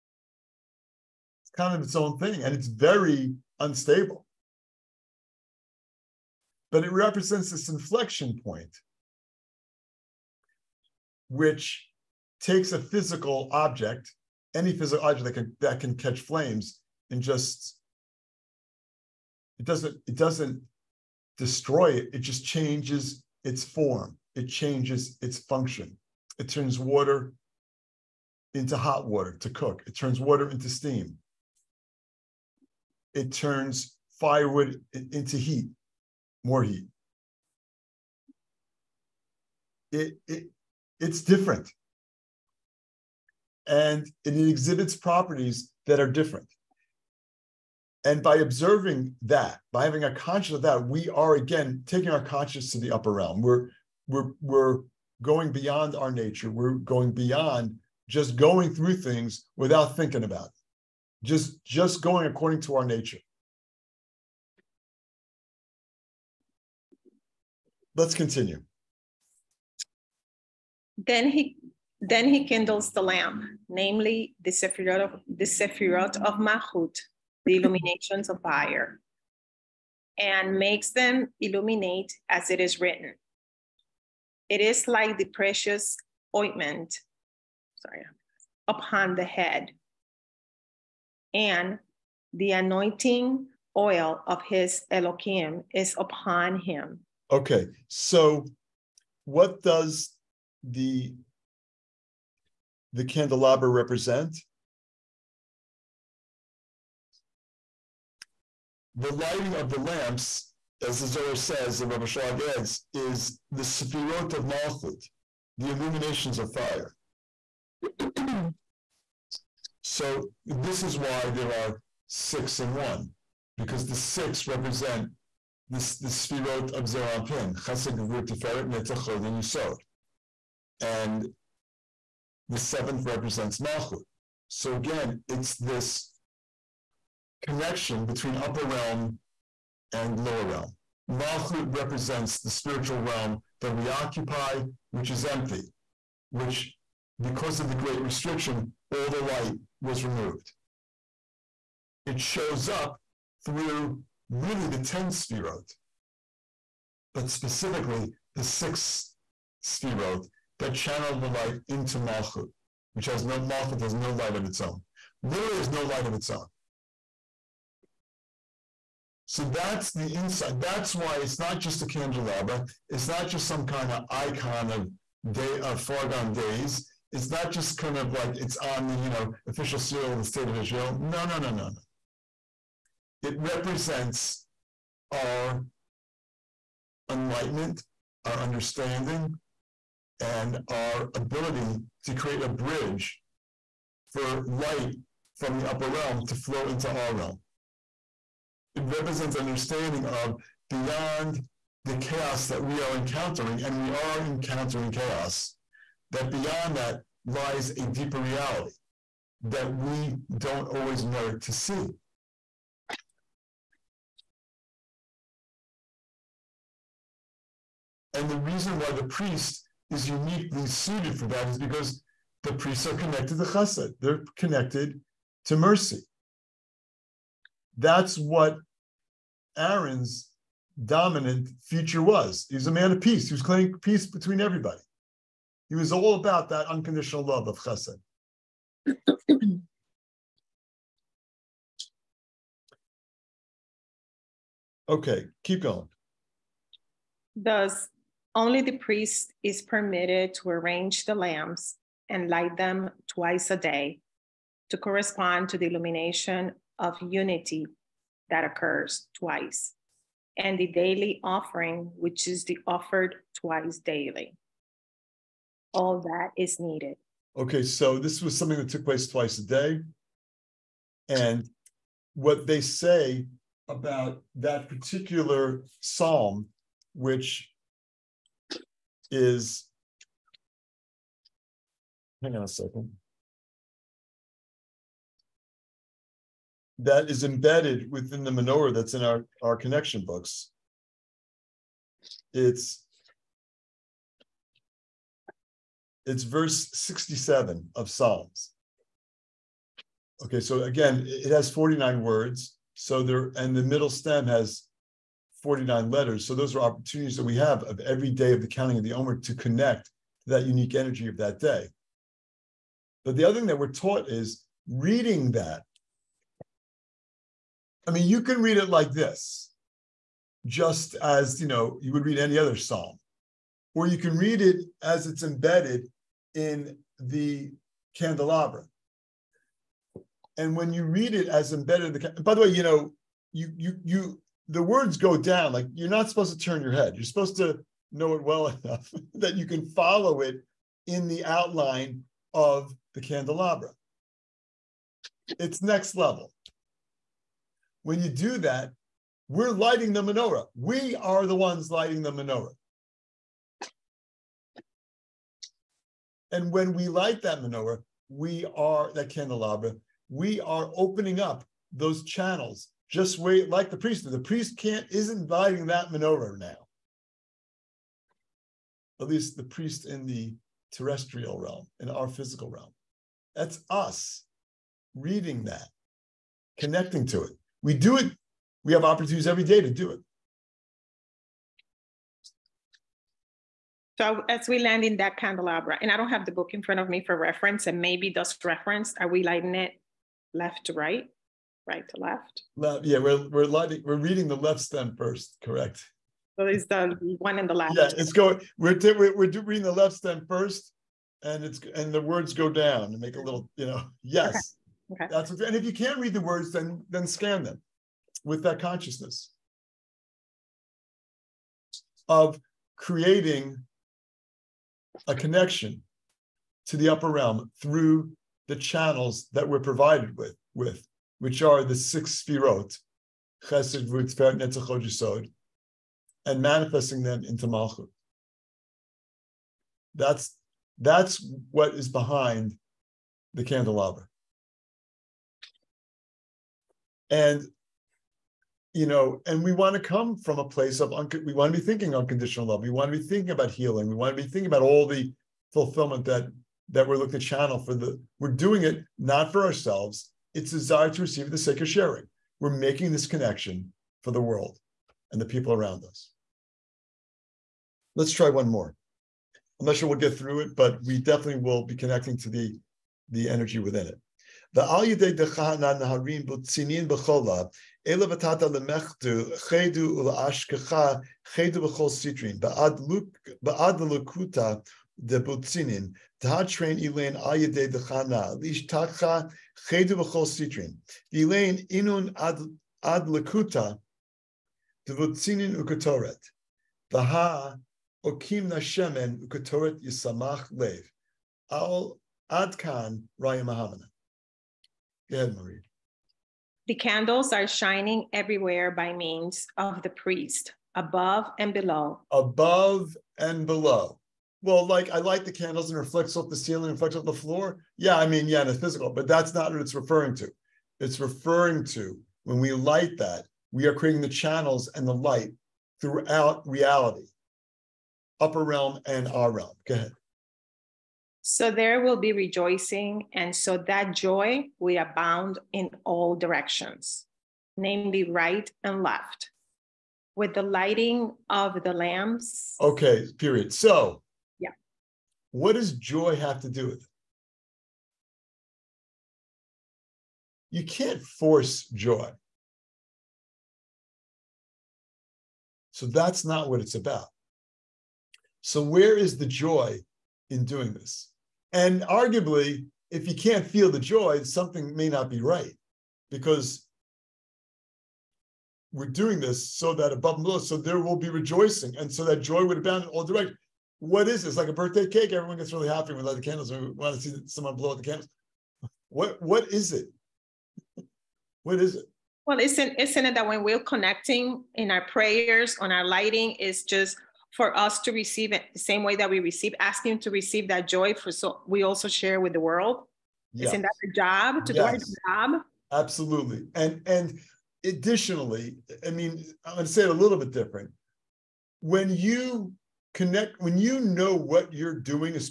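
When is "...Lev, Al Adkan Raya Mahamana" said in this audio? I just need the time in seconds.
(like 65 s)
490 s.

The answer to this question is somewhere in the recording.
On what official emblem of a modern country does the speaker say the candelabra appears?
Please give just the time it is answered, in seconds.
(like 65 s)
179 s.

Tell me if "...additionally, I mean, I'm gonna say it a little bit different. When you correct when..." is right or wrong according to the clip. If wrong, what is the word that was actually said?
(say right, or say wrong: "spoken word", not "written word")
wrong: "connect", not "correct".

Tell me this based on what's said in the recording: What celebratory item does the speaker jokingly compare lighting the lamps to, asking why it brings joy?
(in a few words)
A birthday cake.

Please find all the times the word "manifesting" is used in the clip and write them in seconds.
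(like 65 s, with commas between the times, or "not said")
426 s.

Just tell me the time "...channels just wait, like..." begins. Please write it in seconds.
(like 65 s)
362 s.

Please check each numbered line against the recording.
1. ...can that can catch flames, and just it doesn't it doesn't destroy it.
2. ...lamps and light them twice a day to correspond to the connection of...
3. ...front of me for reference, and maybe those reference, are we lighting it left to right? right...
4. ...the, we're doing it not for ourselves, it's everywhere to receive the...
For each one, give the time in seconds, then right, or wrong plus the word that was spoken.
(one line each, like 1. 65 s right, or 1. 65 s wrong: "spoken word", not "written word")
1. 15 s right
2. 251 s wrong: "illumination", not "connection"
3. 386 s right
4. 447 s wrong: "desire", not "everywhere".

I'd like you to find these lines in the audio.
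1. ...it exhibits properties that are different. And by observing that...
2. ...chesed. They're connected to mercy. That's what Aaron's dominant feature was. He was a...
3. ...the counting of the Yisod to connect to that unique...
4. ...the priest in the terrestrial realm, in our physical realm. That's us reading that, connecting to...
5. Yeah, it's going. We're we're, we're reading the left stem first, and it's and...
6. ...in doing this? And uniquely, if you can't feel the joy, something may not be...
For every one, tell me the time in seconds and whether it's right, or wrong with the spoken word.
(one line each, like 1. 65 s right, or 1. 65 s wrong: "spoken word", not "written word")
1. 44 s right
2. 223 s right
3. 308 s wrong: "Omer", not "Yisod"
4. 369 s right
5. 397 s right
6. 550 s wrong: "arguably", not "uniquely".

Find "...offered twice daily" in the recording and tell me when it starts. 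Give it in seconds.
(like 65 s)
262 s.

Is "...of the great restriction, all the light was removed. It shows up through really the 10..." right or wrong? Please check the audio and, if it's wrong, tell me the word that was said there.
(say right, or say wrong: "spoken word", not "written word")
right.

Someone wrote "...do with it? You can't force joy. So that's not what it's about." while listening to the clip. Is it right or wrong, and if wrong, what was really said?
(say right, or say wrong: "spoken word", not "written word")
right.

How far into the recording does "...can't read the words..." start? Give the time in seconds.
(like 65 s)
405 s.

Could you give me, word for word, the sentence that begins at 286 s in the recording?
That is embedded within the menorah that's in our, our connection books.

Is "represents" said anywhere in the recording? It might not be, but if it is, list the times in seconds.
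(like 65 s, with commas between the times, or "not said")
6 s, 103 s, 124 s, 133 s, 141 s, 183 s, 198 s.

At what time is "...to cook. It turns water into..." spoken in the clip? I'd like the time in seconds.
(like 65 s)
29 s.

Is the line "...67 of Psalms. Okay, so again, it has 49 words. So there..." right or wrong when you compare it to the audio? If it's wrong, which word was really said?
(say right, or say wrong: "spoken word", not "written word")
right.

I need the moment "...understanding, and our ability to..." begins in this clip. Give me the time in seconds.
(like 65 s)
188 s.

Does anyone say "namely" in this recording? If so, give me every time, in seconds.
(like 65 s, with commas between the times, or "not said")
73 s, 527 s.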